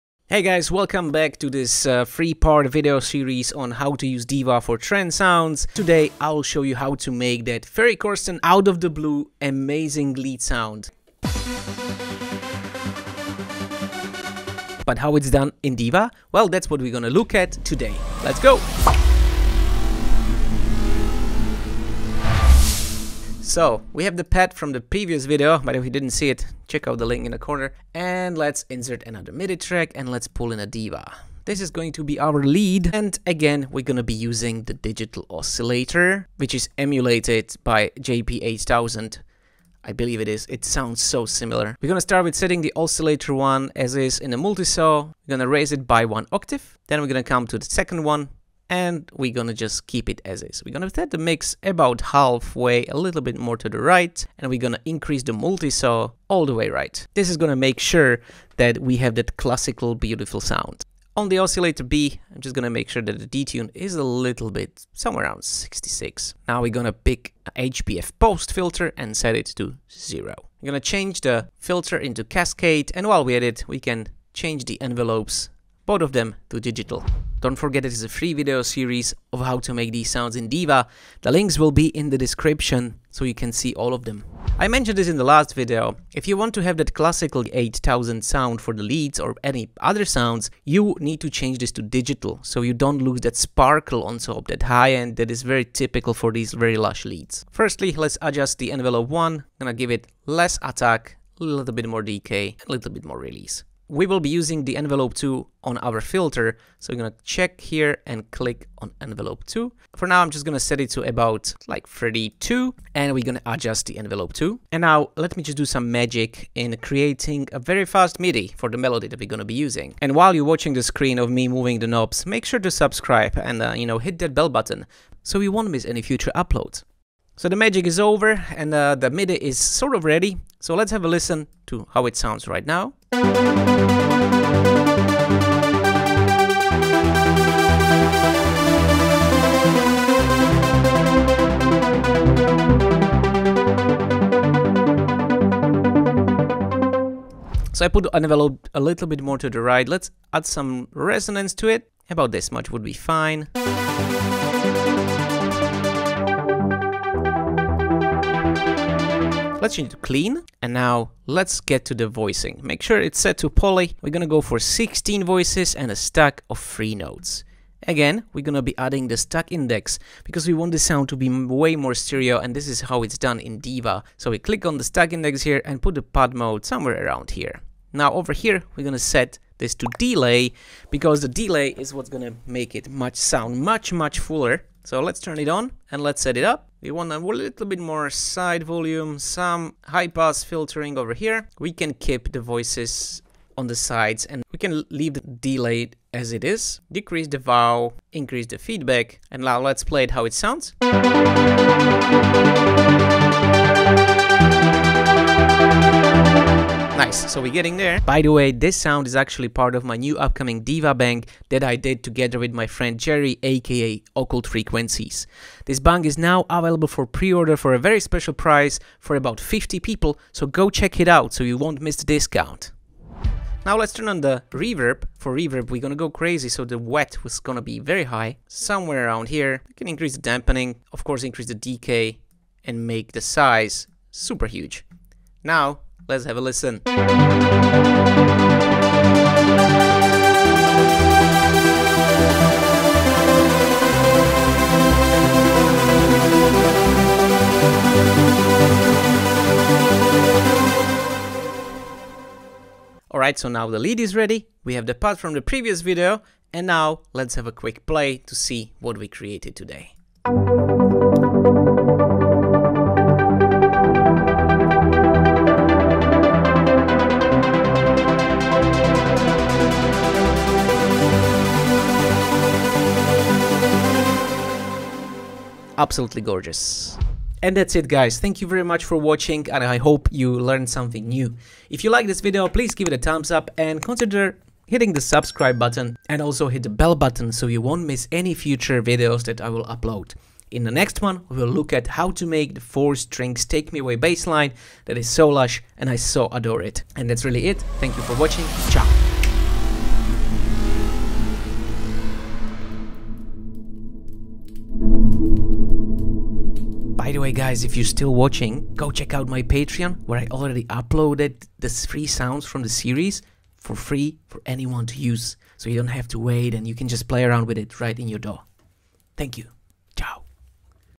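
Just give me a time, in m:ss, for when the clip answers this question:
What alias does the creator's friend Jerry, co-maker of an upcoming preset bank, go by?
3:34.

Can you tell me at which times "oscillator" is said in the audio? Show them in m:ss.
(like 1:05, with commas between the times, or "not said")
0:35, 0:42, 1:01.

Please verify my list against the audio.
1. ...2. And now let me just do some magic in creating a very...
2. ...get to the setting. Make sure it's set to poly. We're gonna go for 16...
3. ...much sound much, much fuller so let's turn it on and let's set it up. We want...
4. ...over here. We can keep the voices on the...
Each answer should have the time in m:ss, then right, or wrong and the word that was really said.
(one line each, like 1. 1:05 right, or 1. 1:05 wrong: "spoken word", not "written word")
1. 1:54 right
2. 2:41 wrong: "voicing", not "setting"
3. 3:02 right
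4. 3:10 right.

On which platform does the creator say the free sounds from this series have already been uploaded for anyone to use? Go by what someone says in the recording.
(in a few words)
Patreon.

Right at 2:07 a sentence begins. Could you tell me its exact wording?
So the magic is over and uh, the MIDI is sort of ready.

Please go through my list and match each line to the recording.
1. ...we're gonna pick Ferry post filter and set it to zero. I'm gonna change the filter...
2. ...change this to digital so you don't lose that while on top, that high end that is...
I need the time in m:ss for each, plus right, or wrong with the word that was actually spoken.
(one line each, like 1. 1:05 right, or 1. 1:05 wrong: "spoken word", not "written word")
1. 1:06 wrong: "HPF", not "Ferry"
2. 1:31 wrong: "sparkle", not "while".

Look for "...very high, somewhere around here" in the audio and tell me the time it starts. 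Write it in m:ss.
3:47.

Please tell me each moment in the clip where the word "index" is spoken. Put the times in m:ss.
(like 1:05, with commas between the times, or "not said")
2:49, 2:55.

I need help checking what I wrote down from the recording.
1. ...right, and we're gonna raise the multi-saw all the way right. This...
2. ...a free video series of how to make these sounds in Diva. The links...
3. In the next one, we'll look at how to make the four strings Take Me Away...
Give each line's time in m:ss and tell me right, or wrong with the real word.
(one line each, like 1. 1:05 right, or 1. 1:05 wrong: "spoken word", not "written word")
1. 0:53 wrong: "increase", not "raise"
2. 1:18 right
3. 4:50 right.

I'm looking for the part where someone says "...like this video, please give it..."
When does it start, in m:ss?
4:41.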